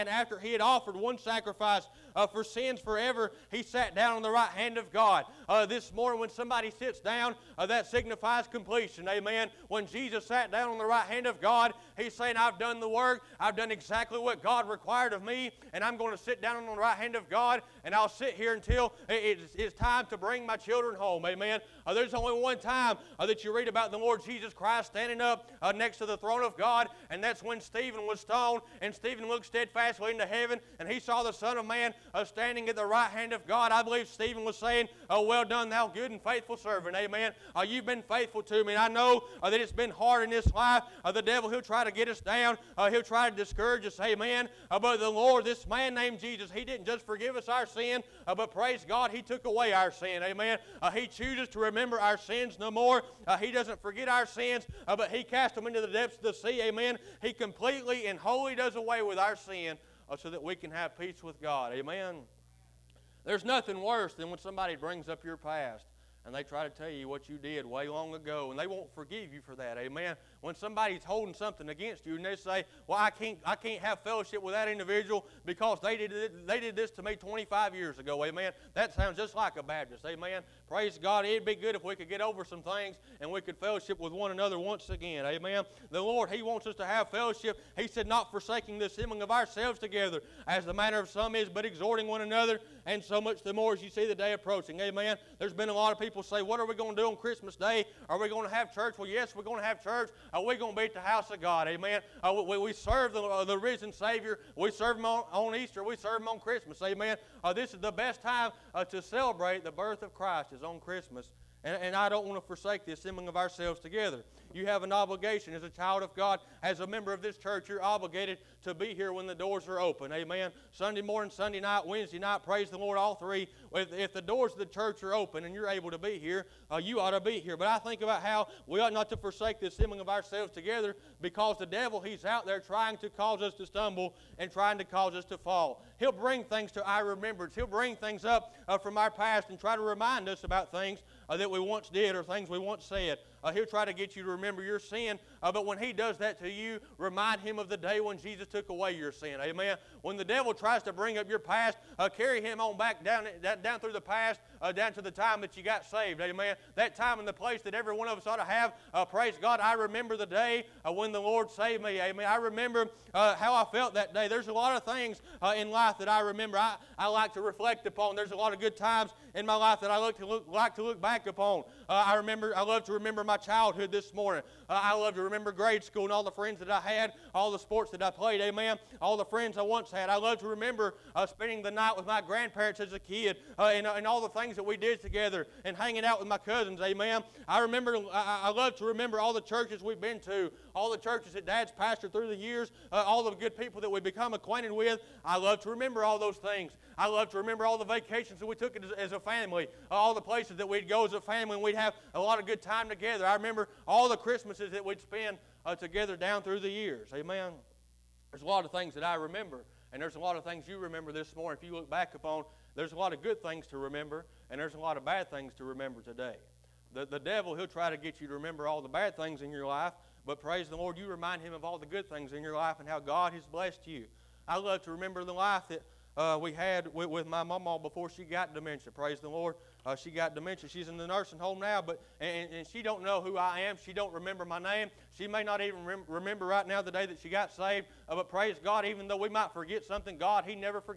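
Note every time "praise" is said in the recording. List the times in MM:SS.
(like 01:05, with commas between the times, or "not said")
00:48, 01:20, 02:02, 02:39, 03:40, 03:48, 03:58.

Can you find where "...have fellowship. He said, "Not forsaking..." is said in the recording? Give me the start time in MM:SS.
01:26.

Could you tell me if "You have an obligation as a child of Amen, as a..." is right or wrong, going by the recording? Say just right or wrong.
wrong.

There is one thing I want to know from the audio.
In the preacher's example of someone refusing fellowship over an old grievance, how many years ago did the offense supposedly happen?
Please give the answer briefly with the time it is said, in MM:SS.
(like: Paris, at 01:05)
25, at 01:17.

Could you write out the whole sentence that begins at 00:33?
I believe Stephen was saying, well, well done, thou good and faithful servant.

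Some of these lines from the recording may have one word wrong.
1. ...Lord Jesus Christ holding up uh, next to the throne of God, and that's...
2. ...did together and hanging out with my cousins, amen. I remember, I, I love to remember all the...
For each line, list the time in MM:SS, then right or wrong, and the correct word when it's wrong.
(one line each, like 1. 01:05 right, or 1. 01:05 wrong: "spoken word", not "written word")
1. 00:23 wrong: "standing", not "holding"
2. 03:04 right.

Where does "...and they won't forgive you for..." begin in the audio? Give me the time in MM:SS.
01:08.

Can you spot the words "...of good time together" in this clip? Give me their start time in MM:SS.
03:22.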